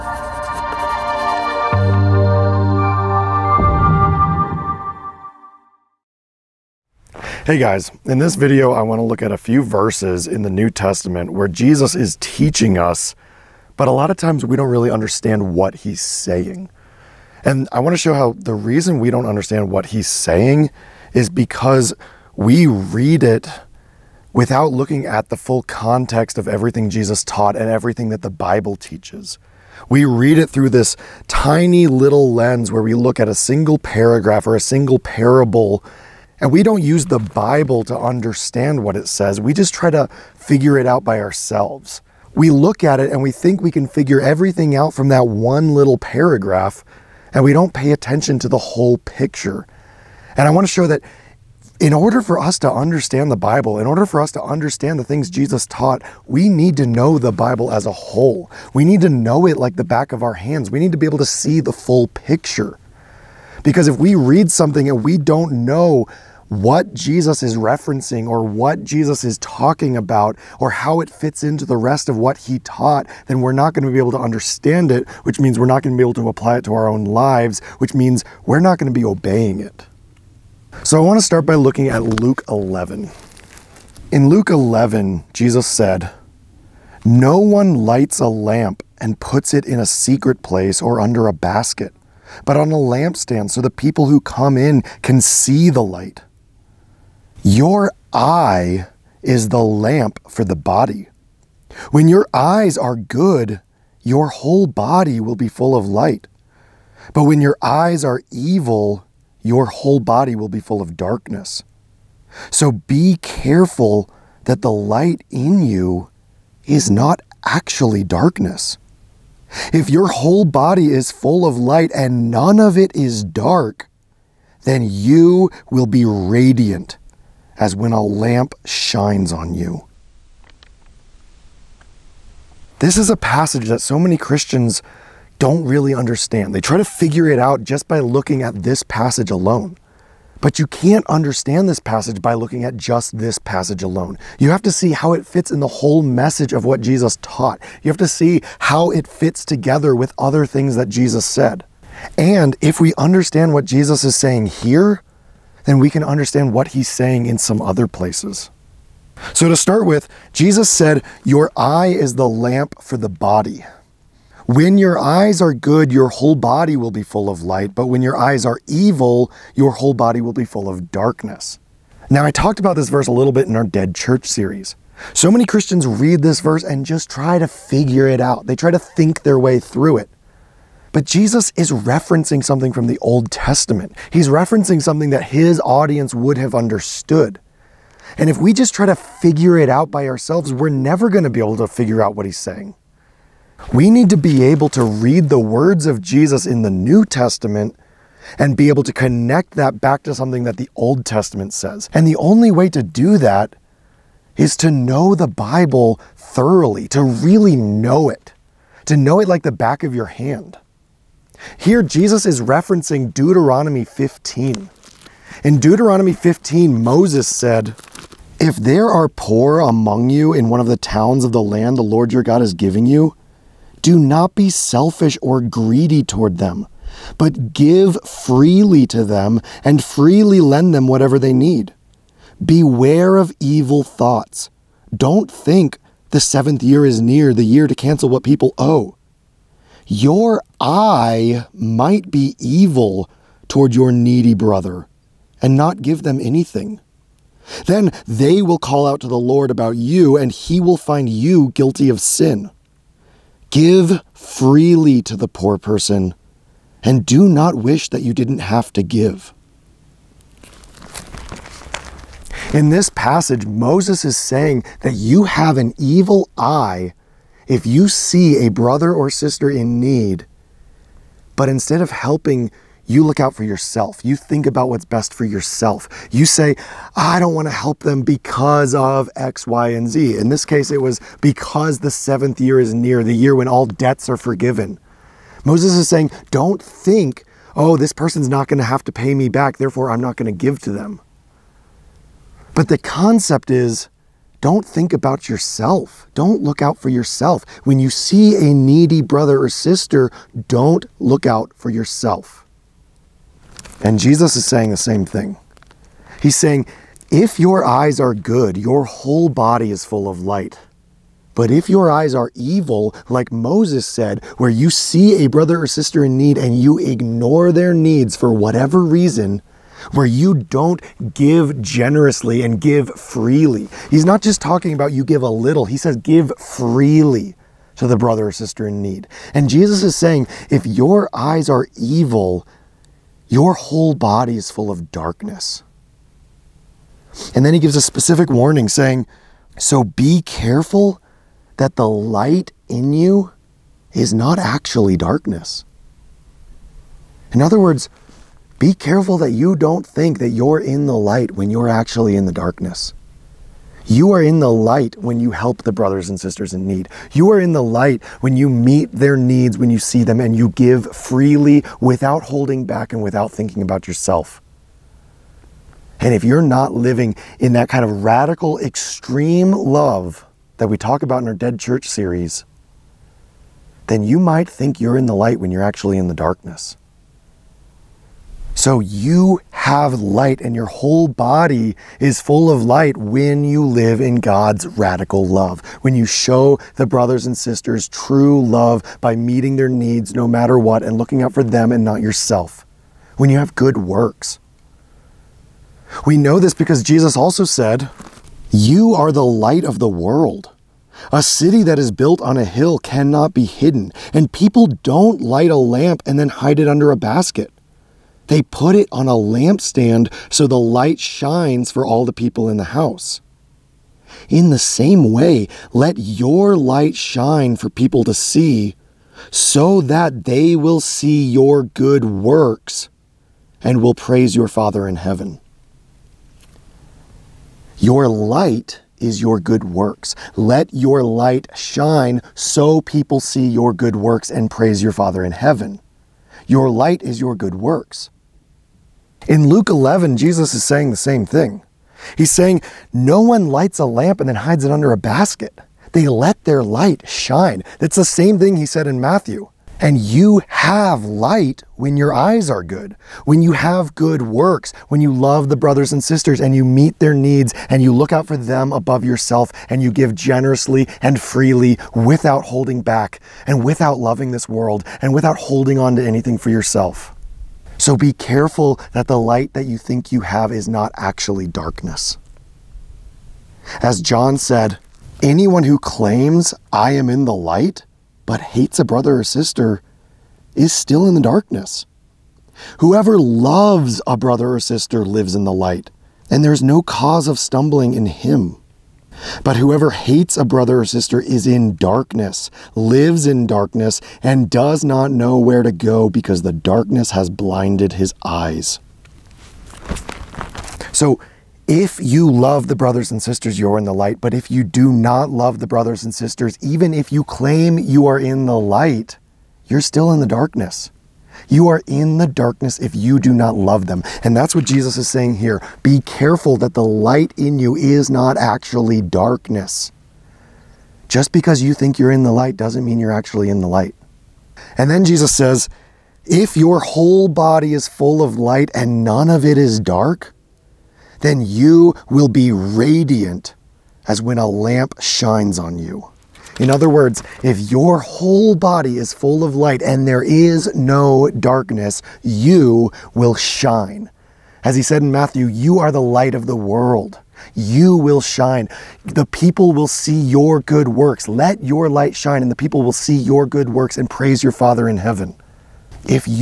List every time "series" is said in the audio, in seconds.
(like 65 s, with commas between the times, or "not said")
174 s, 371 s.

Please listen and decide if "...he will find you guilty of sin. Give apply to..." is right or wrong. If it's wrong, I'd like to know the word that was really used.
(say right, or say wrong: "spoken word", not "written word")
wrong: "freely", not "apply".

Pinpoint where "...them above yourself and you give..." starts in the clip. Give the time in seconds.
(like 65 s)
458 s.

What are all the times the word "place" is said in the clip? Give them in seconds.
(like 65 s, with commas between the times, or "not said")
90 s, 157 s.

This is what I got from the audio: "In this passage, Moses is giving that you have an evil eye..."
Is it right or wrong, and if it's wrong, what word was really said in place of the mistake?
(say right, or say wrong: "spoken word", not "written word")
wrong: "saying", not "giving".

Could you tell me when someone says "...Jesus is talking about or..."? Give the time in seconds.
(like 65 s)
68 s.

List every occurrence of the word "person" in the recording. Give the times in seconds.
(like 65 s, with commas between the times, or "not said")
255 s, 287 s.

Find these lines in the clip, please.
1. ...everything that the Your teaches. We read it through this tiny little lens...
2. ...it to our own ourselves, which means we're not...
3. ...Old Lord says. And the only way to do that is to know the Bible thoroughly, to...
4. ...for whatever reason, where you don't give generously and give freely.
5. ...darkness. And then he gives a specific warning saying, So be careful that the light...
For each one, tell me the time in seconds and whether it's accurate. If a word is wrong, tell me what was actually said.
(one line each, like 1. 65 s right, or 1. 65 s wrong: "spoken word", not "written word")
1. 27 s wrong: "Bible", not "Your"
2. 76 s wrong: "lives", not "ourselves"
3. 200 s wrong: "Testament", not "Lord"
4. 318 s right
5. 334 s right.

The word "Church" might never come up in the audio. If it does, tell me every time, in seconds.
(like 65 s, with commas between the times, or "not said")
173 s, 371 s.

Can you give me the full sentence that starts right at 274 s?
You think about what's best for yourself.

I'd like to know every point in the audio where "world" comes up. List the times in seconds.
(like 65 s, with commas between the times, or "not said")
399 s, 464 s, 546 s.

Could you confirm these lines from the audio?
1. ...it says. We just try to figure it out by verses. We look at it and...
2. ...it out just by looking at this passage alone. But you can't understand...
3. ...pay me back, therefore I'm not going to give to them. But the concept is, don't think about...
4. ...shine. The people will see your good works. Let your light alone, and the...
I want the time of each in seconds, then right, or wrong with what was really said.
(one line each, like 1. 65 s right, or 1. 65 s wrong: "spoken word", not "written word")
1. 38 s wrong: "ourselves", not "verses"
2. 137 s right
3. 288 s right
4. 548 s wrong: "shine", not "alone".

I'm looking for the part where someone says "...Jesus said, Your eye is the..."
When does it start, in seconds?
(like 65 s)
160 s.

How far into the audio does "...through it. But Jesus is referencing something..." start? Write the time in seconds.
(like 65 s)
179 s.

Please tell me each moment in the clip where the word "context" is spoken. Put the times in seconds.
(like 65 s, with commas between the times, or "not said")
25 s.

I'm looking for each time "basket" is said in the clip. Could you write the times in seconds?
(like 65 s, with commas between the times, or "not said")
91 s, 406 s, 444 s.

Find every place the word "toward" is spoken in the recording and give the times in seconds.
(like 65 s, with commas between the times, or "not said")
226 s, 243 s.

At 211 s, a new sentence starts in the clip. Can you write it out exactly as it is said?
Here, Jesus is referencing Deuteronomy 15.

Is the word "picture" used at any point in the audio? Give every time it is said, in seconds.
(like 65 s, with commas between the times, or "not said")
48 s, 62 s.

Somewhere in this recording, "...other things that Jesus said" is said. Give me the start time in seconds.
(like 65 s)
150 s.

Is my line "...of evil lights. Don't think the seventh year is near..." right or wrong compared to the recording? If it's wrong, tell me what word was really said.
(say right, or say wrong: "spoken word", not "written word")
wrong: "thoughts", not "lights".